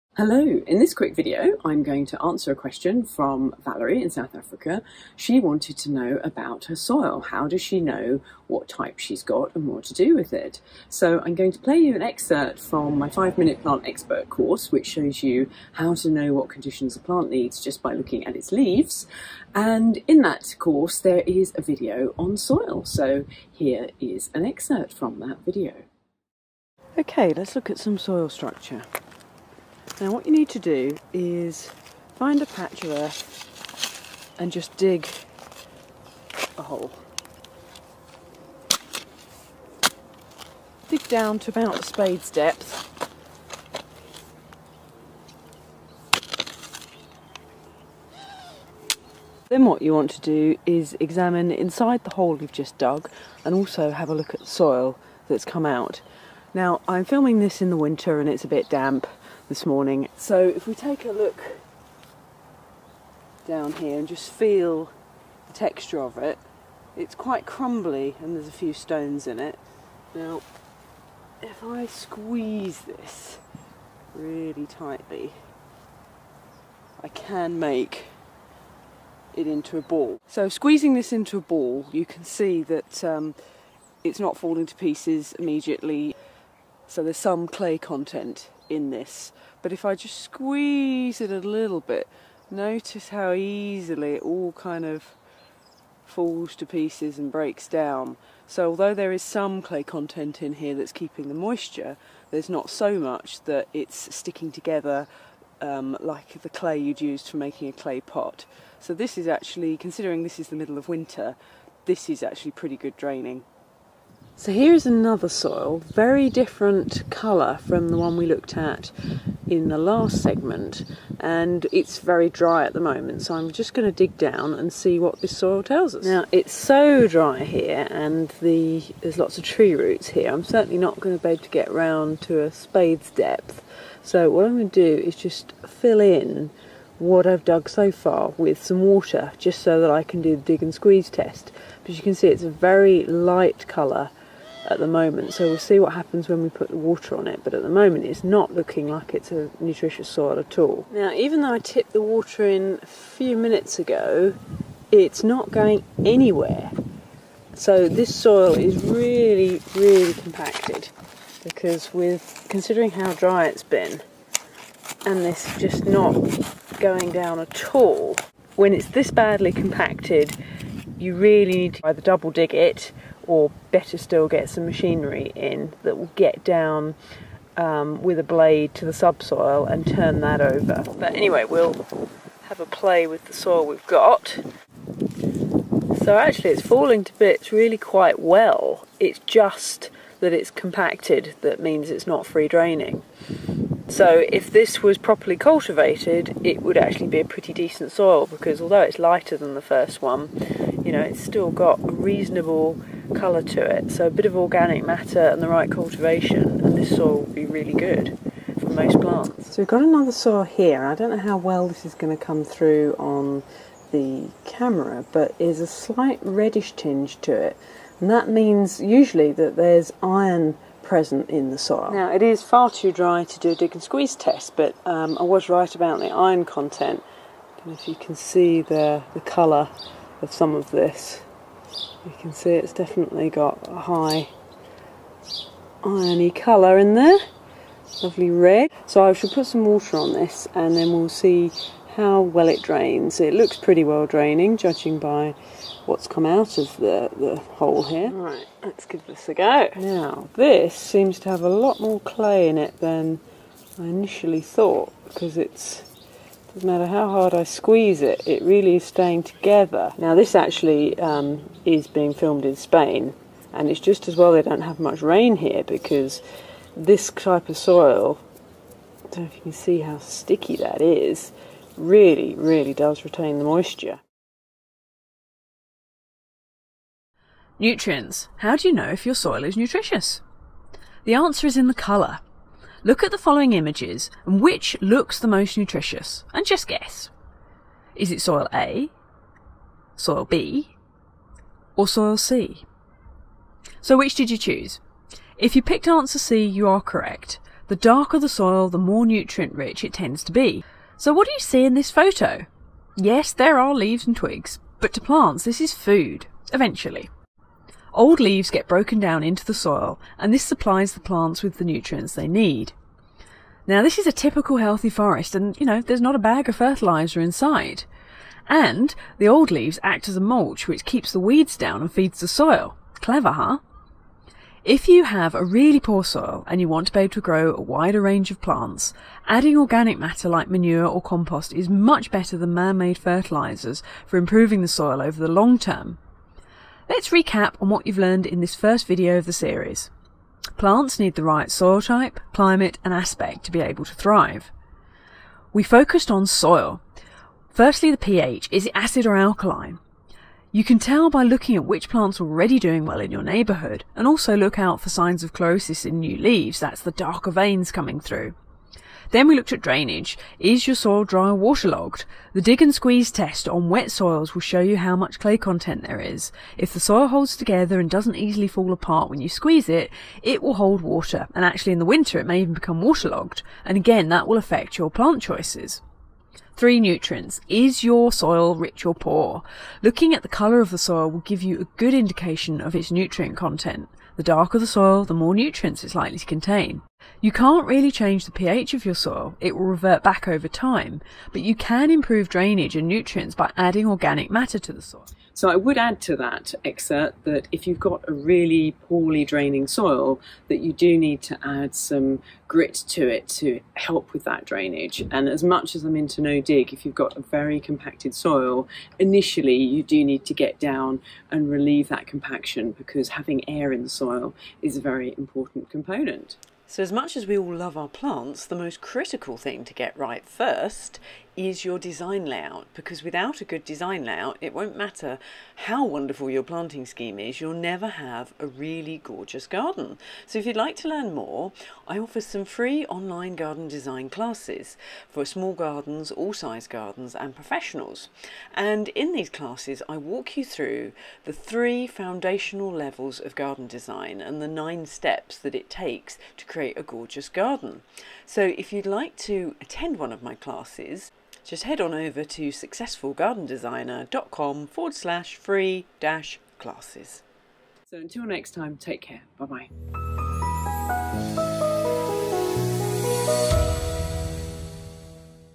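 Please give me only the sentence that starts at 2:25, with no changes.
So we'll see what happens when we put the water on it.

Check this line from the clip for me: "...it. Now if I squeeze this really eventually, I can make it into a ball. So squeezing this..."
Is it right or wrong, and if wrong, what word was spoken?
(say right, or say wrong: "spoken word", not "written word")
wrong: "tightly", not "eventually".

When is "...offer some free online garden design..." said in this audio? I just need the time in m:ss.
7:11.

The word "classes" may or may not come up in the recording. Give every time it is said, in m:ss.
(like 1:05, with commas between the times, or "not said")
7:14, 7:19, 7:30, 7:36.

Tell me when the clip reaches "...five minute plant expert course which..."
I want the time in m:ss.
0:13.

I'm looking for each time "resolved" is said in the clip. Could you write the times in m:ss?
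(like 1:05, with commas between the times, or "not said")
not said.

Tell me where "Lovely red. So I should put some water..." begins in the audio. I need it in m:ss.
3:58.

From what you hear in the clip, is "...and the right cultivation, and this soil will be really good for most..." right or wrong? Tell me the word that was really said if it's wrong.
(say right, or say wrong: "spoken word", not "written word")
right.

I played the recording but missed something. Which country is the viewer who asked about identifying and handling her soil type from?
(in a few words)
South Africa.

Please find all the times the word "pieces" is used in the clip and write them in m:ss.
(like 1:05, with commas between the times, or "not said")
1:24, 1:36.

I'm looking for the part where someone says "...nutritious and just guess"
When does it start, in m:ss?
4:45.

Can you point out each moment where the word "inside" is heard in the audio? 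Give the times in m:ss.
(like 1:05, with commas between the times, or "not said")
0:51, 5:17.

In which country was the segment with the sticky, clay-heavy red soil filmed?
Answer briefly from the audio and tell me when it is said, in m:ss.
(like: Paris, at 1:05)
Spain, at 4:22.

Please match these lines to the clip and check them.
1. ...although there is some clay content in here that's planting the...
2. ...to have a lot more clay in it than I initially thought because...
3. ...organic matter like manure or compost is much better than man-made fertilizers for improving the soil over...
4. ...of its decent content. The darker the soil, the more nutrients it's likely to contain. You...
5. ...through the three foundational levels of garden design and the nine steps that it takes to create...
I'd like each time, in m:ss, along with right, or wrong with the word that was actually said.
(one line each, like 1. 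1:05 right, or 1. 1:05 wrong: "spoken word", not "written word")
1. 1:38 wrong: "keeping", not "planting"
2. 4:11 right
3. 5:29 right
4. 6:22 wrong: "nutrient", not "decent"
5. 7:20 right.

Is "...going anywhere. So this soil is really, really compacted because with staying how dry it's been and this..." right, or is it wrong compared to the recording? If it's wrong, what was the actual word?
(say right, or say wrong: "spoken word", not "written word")
wrong: "considering", not "staying".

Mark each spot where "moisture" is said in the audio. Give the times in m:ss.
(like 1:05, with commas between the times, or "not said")
1:41, 4:33.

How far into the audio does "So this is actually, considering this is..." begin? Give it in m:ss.
1:48.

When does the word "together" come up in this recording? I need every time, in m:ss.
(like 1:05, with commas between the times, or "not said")
1:44, 4:19, 6:07.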